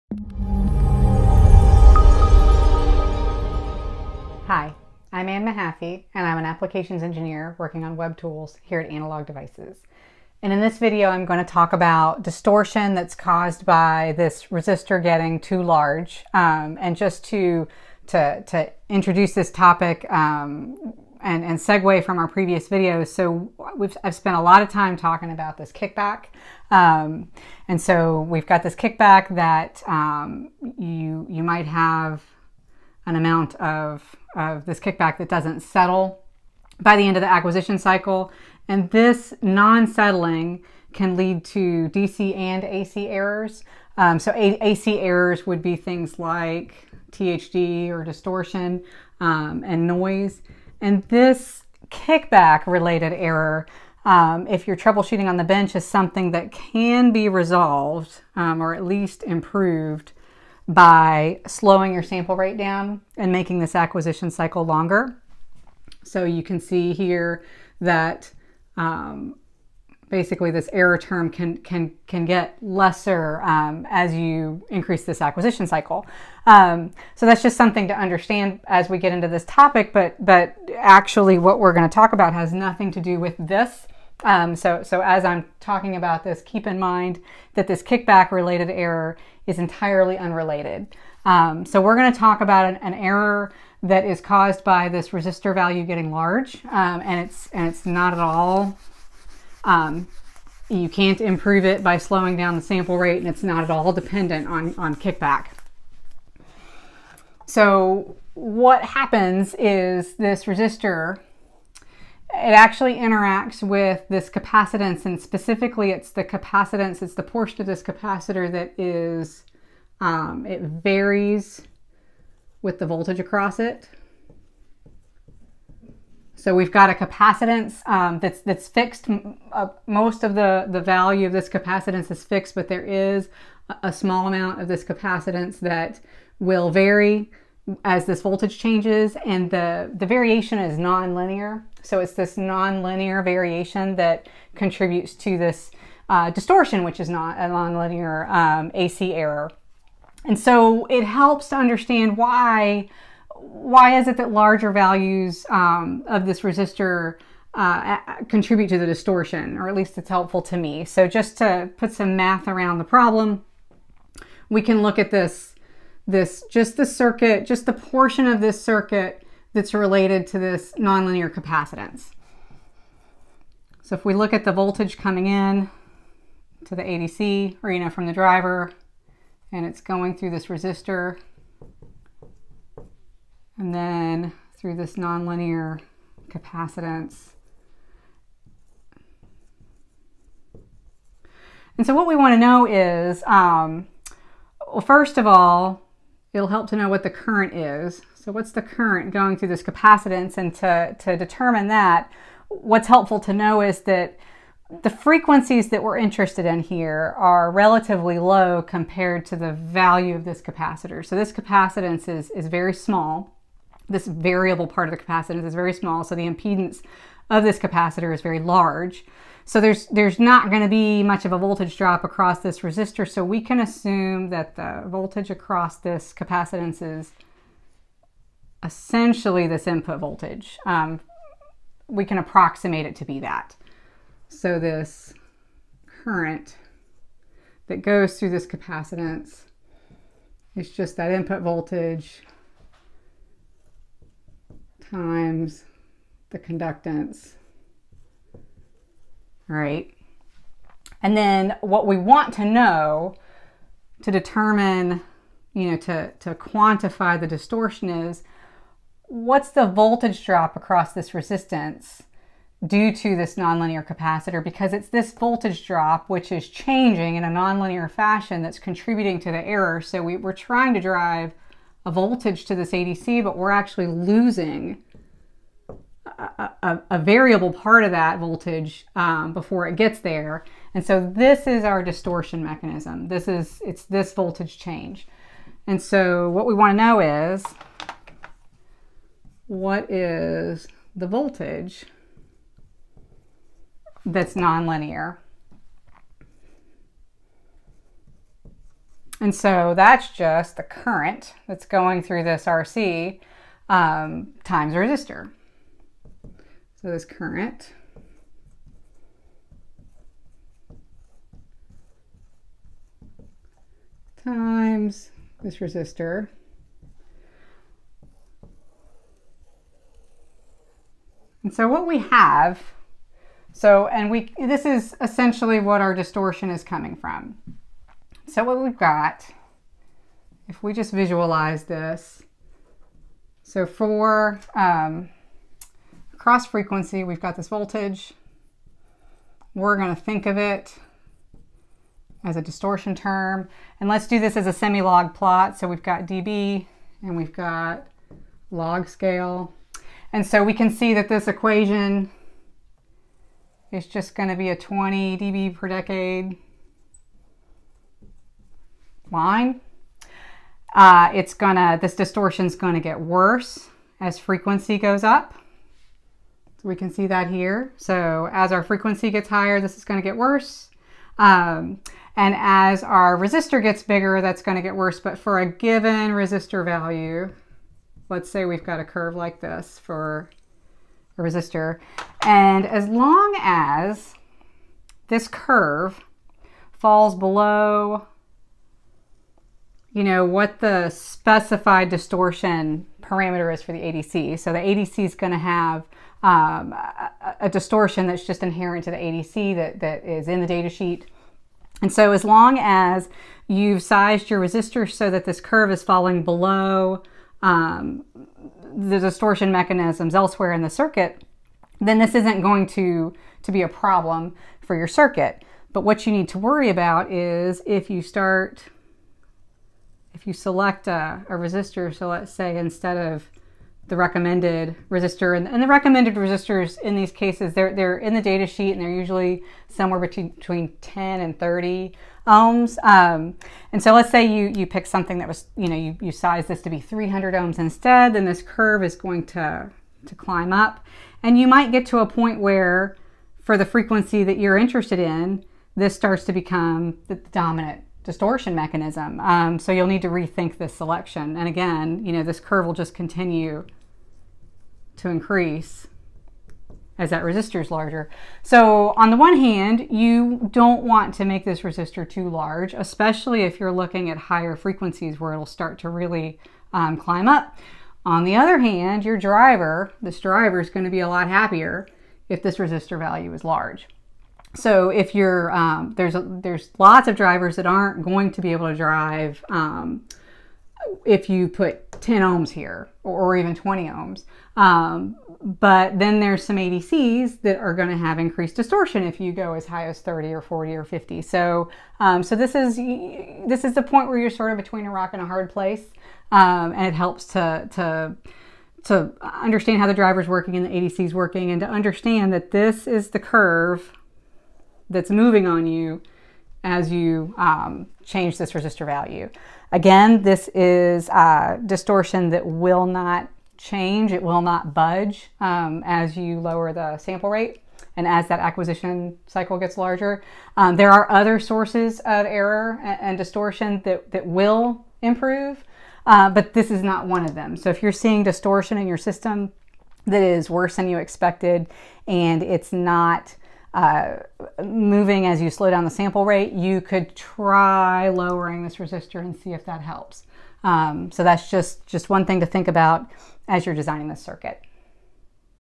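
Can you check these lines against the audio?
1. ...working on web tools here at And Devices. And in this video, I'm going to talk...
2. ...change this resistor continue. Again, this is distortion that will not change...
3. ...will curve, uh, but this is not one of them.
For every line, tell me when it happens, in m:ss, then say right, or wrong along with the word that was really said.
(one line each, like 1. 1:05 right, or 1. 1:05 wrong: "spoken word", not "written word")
1. 0:07 wrong: "Analog", not "And"
2. 8:28 wrong: "value", not "continue"
3. 8:44 wrong: "improve", not "curve".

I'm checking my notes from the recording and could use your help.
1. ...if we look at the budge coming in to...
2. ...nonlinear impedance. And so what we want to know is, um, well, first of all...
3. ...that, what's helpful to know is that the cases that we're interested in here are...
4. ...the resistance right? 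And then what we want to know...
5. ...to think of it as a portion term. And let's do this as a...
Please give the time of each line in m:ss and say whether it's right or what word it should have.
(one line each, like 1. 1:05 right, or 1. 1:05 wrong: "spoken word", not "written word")
1. 2:53 wrong: "voltage", not "budge"
2. 3:04 wrong: "capacitance", not "impedance"
3. 3:21 wrong: "frequencies", not "cases"
4. 4:06 wrong: "conductance", not "resistance"
5. 5:39 wrong: "distortion", not "portion".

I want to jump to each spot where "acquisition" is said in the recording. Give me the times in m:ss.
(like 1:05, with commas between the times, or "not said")
0:37, 1:03, 1:15, 8:38.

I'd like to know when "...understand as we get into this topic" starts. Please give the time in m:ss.
1:17.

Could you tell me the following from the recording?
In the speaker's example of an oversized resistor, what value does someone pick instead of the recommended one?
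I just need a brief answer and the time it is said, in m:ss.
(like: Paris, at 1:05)
300 ohms, at 7:16.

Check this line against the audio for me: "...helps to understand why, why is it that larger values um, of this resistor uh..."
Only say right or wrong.
right.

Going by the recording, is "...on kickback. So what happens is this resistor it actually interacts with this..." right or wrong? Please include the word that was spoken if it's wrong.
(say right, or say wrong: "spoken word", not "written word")
right.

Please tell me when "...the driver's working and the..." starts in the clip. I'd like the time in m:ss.
8:19.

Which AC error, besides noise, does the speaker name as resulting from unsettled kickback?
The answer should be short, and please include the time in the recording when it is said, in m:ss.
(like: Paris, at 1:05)
THD, at 0:47.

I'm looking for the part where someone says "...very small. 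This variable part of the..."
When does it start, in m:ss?
3:32.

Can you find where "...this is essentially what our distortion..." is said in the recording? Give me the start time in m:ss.
5:24.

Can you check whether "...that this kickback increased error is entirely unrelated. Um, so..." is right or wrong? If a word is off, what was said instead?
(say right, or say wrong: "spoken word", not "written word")
wrong: "related", not "increased".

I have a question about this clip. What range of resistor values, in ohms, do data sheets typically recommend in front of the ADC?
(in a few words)
10 to 30 ohms.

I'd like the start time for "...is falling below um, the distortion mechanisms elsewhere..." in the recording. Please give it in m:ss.
6:45.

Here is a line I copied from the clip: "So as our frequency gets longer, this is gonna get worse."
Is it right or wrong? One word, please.
wrong.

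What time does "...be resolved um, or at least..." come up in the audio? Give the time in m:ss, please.
0:57.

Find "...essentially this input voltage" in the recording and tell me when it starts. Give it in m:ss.
3:48.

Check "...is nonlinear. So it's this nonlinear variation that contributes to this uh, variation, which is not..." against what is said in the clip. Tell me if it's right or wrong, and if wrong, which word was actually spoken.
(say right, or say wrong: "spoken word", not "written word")
wrong: "distortion", not "variation".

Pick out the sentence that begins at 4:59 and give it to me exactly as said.
And so that's just the current that's going through this RC um, times resistor.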